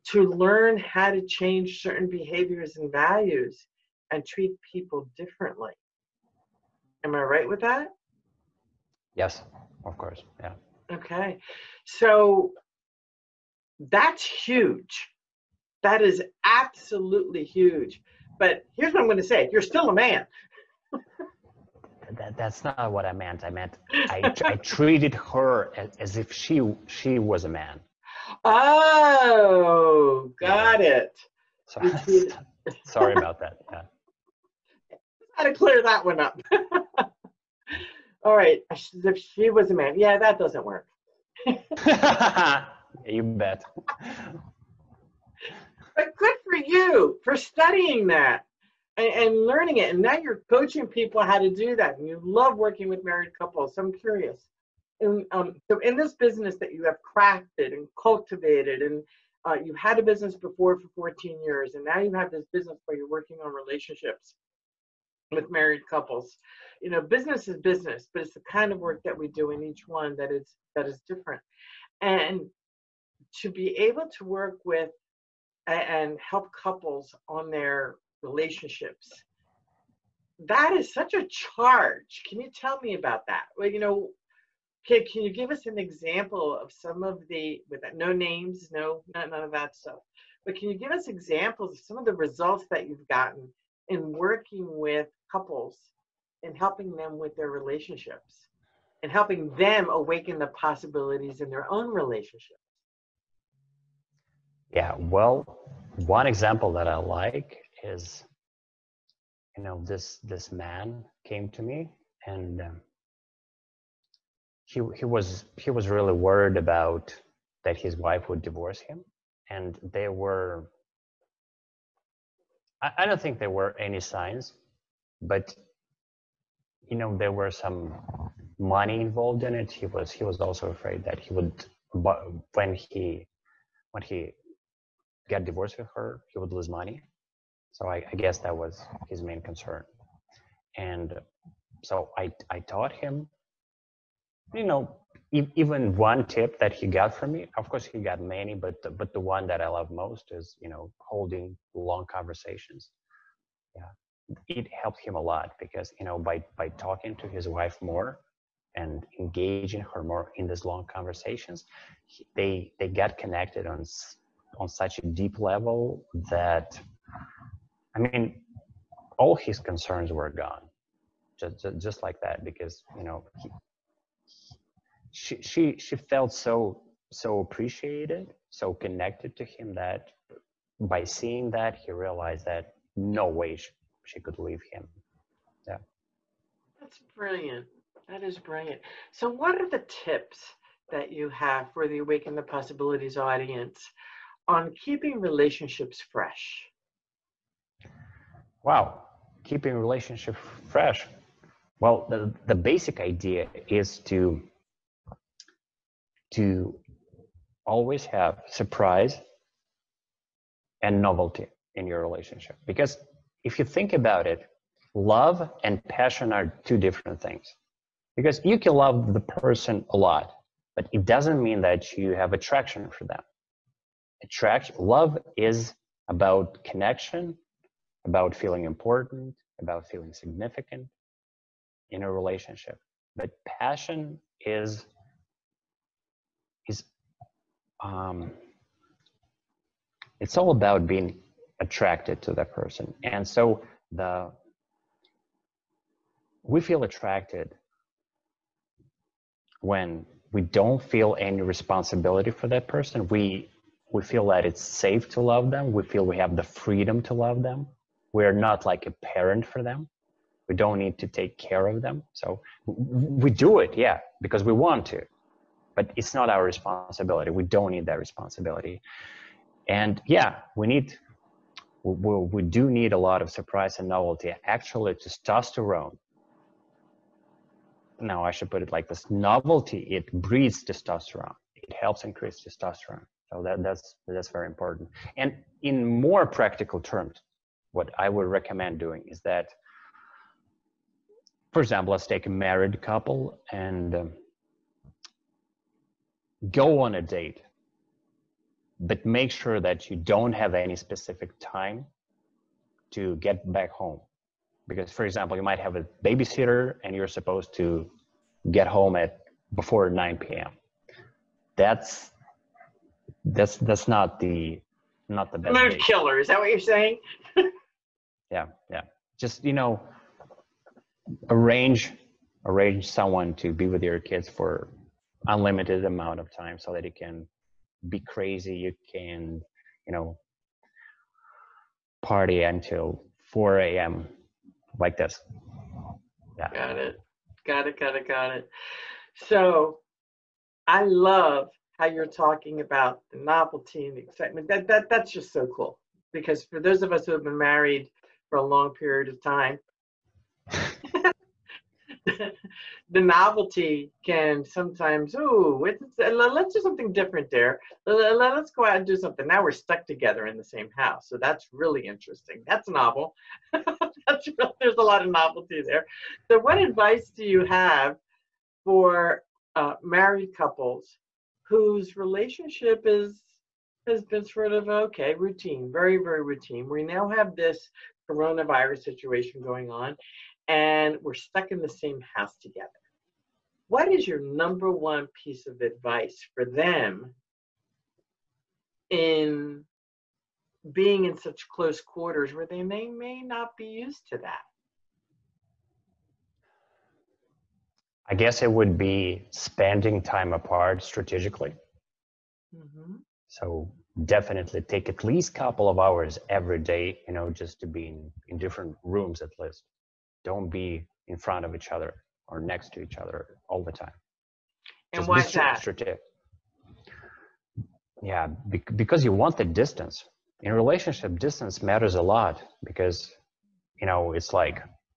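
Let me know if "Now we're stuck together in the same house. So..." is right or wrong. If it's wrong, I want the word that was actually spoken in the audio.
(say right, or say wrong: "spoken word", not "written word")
right.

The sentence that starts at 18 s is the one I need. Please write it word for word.
But here's what I'm going to say you're still a man.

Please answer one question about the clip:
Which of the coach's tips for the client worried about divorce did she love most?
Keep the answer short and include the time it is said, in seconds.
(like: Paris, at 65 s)
holding long conversations, at 150 s.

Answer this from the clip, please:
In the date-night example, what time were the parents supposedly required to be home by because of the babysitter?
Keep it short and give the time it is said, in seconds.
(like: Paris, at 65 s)
9 p.m., at 309 s.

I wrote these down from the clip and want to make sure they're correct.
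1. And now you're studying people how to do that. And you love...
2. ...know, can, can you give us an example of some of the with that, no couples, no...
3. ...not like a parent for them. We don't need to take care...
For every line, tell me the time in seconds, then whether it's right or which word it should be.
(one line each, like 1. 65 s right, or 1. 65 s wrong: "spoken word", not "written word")
1. 49 s wrong: "coaching", not "studying"
2. 83 s wrong: "names", not "couples"
3. 258 s right.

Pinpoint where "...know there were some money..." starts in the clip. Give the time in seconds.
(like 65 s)
126 s.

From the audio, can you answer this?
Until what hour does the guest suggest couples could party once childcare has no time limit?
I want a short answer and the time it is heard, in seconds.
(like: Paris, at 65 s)
4 a.m., at 333 s.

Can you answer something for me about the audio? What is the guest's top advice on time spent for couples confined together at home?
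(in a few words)
spending time apart strategically.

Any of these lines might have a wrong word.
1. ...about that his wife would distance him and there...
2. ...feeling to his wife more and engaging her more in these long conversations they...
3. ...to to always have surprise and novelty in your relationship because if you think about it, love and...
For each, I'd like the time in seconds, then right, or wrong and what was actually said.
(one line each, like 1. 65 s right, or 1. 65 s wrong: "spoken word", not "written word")
1. 116 s wrong: "divorce", not "distance"
2. 156 s wrong: "talking", not "feeling"
3. 204 s right.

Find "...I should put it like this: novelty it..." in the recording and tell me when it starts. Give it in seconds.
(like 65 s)
278 s.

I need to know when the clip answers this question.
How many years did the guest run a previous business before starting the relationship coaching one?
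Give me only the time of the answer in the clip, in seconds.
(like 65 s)
60 s.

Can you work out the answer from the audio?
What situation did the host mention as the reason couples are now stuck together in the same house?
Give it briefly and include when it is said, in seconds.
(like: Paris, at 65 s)
coronavirus, at 378 s.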